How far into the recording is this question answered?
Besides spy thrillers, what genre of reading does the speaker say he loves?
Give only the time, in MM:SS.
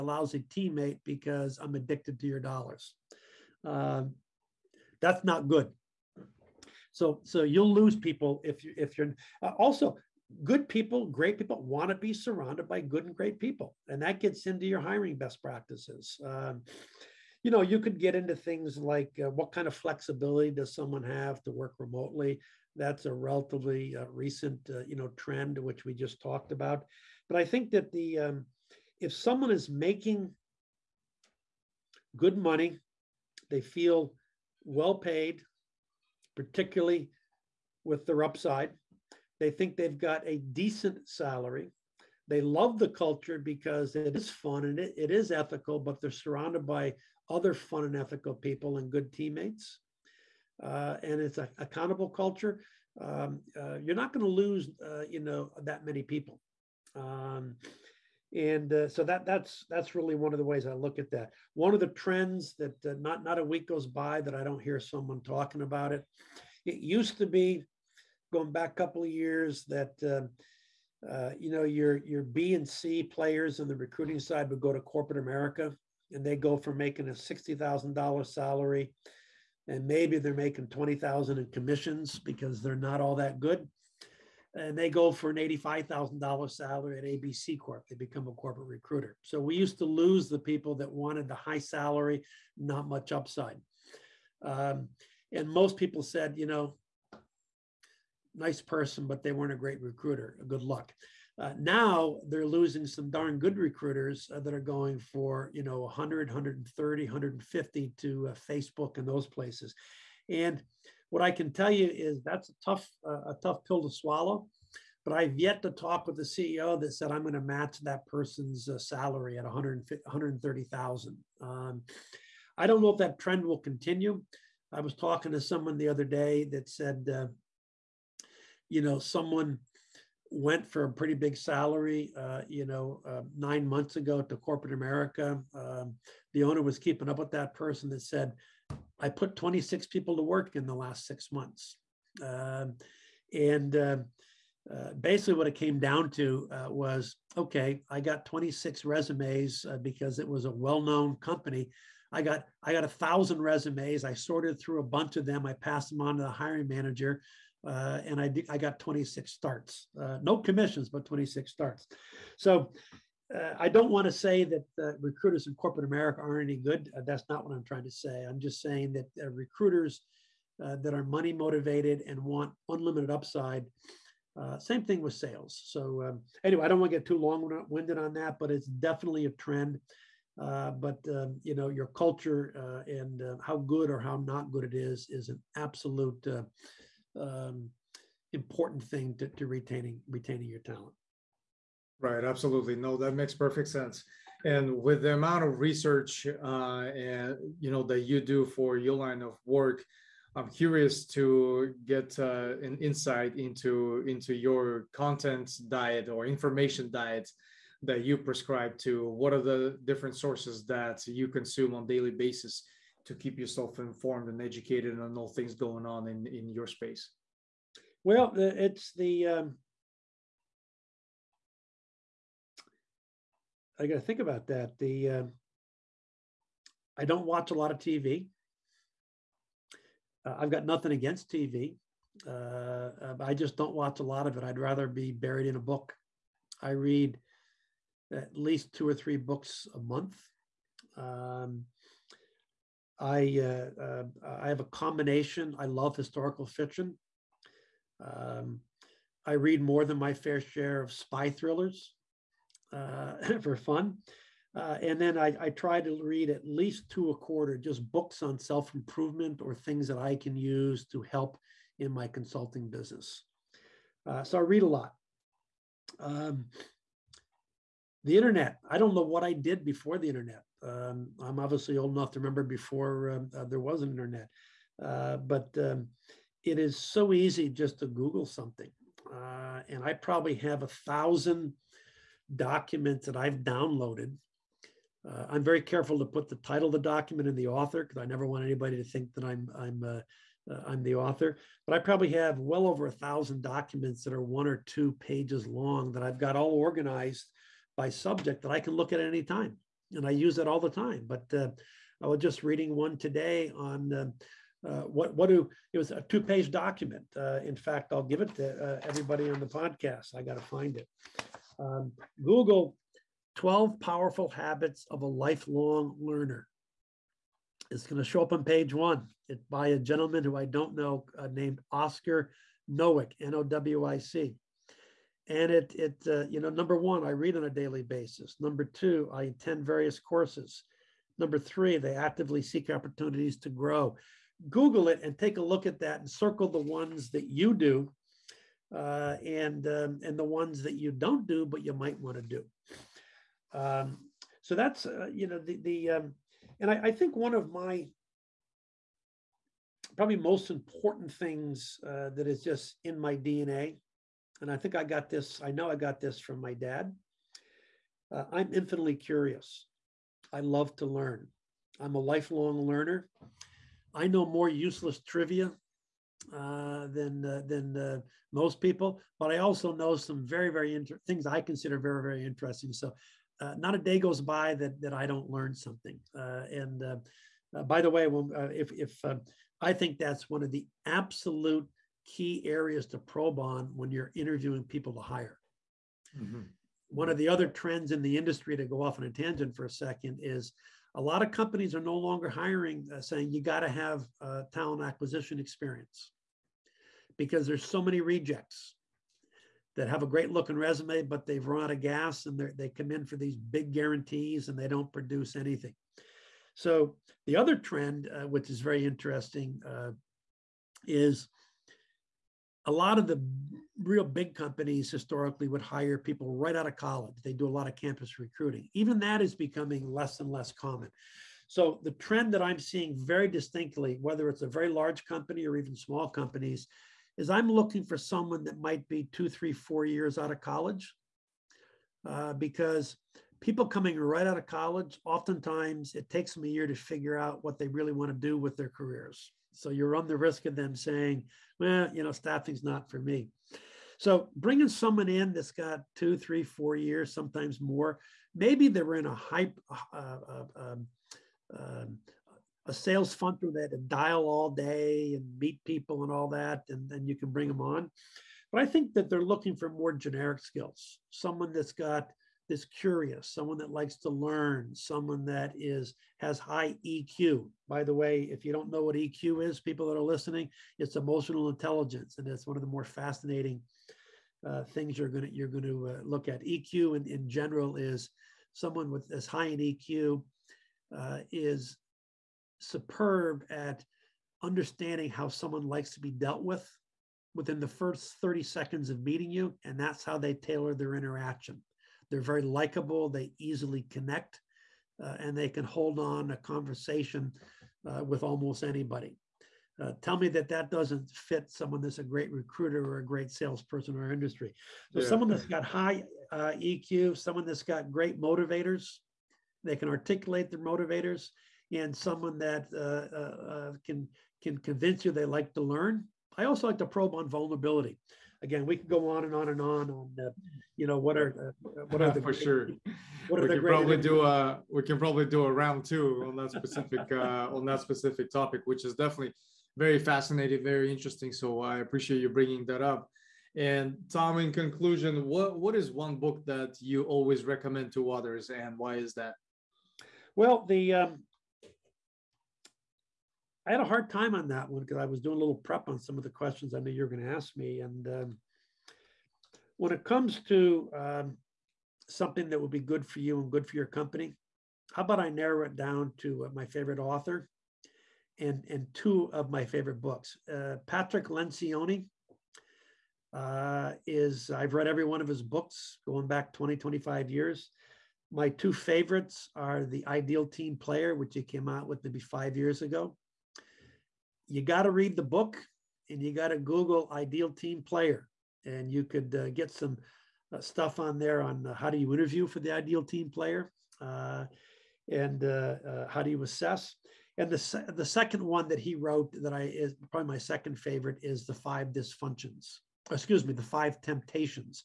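04:05.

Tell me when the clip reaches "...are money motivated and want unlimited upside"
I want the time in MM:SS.
02:50.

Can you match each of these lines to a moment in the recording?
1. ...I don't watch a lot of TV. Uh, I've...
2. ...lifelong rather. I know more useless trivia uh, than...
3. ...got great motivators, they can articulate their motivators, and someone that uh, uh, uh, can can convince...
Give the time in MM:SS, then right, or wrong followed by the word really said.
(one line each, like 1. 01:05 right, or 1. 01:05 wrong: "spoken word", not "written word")
1. 03:46 right
2. 06:01 wrong: "learner", not "rather"
3. 08:27 right.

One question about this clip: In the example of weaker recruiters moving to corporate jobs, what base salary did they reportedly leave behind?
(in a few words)
$60,000.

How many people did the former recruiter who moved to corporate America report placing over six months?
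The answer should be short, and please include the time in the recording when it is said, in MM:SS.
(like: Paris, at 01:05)
26, at 02:19.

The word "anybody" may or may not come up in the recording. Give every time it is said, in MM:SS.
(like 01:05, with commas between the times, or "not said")
04:48, 08:18.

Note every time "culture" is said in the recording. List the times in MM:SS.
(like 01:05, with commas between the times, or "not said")
00:42, 00:52, 03:01.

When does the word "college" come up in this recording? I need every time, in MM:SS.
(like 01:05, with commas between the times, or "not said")
06:56, 07:10, 07:14.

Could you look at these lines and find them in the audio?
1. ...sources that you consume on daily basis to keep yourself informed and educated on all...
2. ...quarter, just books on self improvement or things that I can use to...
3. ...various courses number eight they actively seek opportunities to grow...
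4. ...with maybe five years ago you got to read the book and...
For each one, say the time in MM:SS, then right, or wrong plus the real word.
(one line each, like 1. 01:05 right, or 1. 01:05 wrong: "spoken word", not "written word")
1. 03:30 right
2. 04:17 right
3. 05:29 wrong: "three", not "eight"
4. 09:31 right.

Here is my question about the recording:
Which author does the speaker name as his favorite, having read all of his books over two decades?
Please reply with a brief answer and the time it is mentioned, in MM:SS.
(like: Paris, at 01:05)
Patrick Lencioni, at 09:20.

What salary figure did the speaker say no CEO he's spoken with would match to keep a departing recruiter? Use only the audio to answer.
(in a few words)
130000.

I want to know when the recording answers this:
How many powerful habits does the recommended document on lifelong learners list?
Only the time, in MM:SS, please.
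05:13.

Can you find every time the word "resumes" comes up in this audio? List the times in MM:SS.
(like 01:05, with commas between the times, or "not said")
02:28, 02:33, 06:40.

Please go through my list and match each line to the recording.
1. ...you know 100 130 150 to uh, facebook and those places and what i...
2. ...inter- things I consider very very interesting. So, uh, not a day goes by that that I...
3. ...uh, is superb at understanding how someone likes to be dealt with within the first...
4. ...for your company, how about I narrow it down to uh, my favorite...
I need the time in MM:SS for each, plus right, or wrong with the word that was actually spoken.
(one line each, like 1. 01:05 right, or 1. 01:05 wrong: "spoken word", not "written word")
1. 01:45 right
2. 06:10 right
3. 08:00 right
4. 09:13 right.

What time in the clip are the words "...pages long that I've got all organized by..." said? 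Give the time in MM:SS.
04:54.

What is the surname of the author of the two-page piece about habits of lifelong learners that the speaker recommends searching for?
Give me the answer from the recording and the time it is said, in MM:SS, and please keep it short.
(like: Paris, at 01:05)
Nowick, at 05:22.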